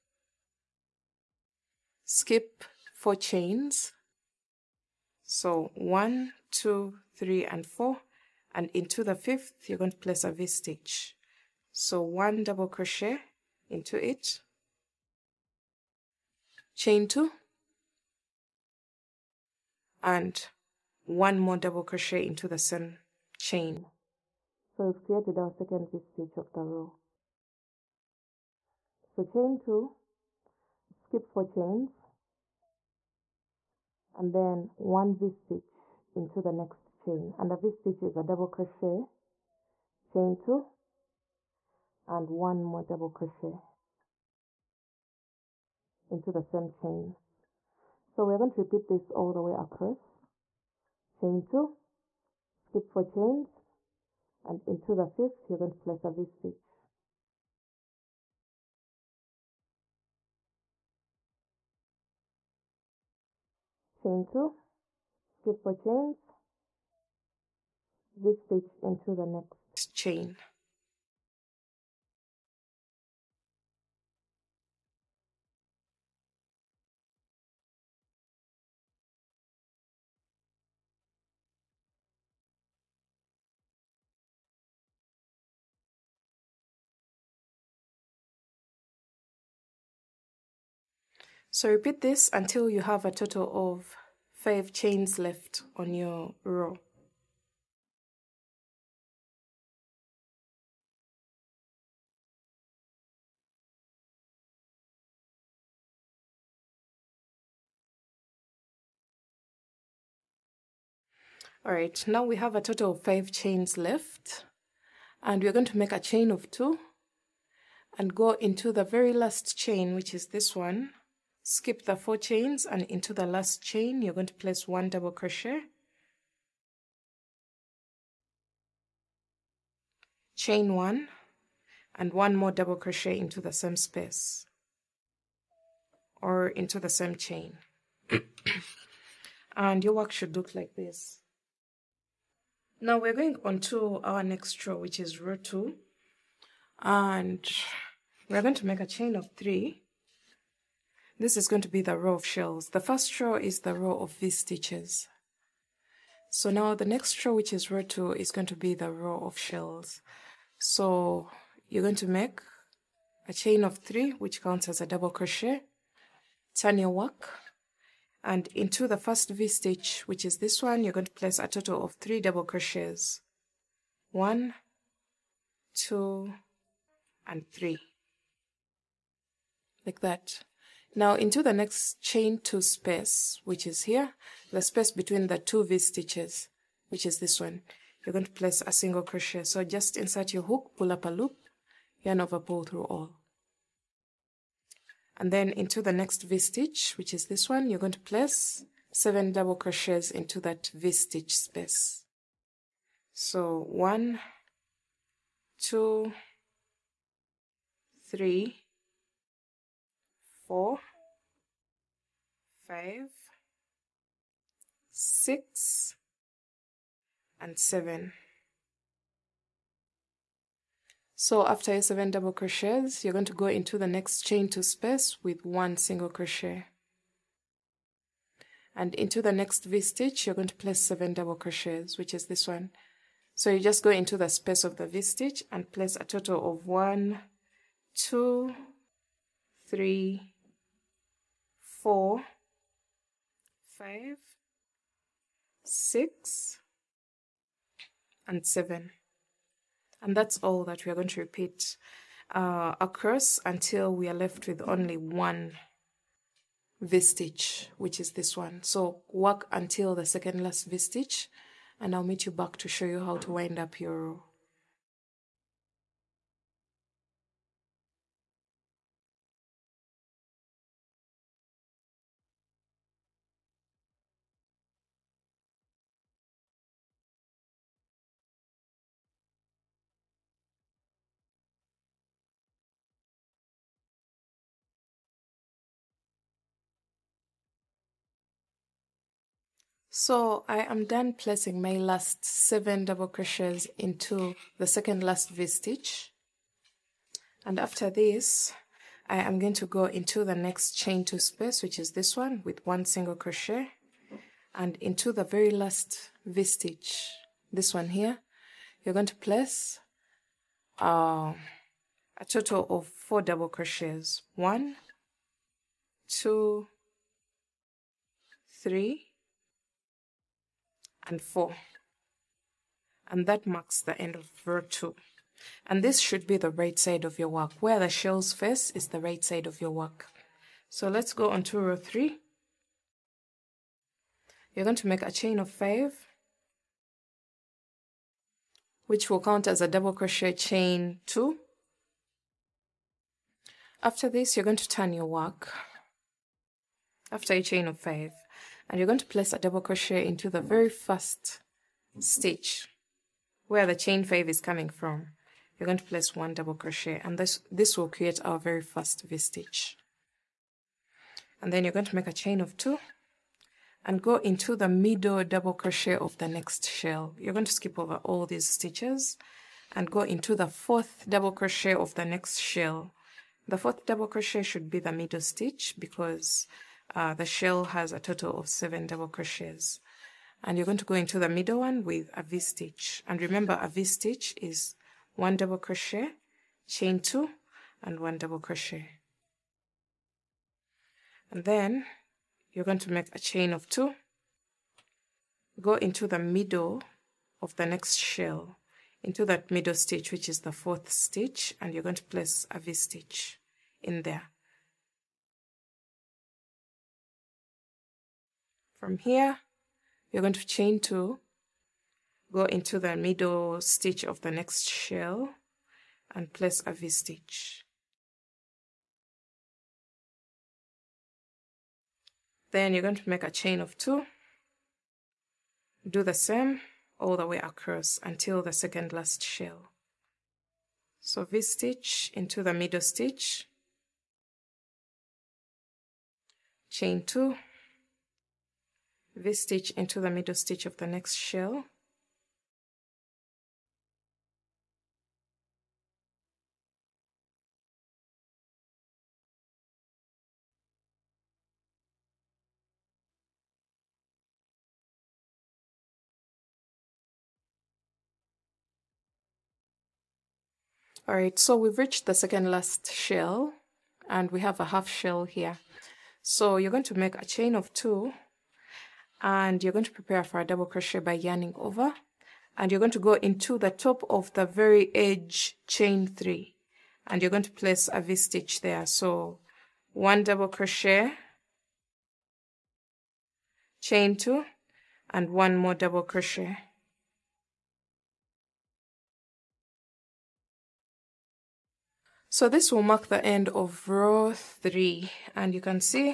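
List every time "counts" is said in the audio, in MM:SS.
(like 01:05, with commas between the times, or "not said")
02:44, 05:39.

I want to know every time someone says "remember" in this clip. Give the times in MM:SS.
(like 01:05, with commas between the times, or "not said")
06:23.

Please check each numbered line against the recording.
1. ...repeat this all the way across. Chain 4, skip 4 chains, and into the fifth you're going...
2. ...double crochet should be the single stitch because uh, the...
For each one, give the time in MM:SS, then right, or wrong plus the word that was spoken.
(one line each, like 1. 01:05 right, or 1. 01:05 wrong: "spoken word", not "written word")
1. 00:48 wrong: "2", not "4"
2. 06:13 wrong: "middle", not "single".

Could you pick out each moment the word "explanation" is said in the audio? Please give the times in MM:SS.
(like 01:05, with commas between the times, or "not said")
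not said.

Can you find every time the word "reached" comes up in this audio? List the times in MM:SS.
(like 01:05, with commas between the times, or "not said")
07:41.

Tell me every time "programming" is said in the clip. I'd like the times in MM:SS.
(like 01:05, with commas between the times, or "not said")
not said.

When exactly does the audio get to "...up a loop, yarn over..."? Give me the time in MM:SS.
03:10.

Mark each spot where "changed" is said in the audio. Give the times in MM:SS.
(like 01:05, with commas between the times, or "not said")
not said.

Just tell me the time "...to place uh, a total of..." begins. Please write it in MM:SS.
05:09.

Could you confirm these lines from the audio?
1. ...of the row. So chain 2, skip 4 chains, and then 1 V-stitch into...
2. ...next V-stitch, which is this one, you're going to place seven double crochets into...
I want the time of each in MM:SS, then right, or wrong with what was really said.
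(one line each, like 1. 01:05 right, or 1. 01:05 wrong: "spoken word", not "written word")
1. 00:26 right
2. 03:15 right.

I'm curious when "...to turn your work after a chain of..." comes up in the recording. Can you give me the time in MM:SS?
05:44.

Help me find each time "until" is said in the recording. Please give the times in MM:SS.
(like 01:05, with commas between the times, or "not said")
01:32, 04:13, 04:19, 07:08.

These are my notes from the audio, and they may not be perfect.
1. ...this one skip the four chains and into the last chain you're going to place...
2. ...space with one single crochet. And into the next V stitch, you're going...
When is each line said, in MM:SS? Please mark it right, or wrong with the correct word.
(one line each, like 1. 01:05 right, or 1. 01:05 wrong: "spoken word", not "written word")
1. 02:00 right
2. 03:44 right.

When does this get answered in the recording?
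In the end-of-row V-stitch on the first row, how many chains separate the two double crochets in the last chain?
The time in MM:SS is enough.
02:10.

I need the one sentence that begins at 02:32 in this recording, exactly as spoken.
The first row is the row of V stitches.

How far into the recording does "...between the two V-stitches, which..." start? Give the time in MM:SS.
03:04.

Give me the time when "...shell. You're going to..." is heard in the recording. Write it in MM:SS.
06:06.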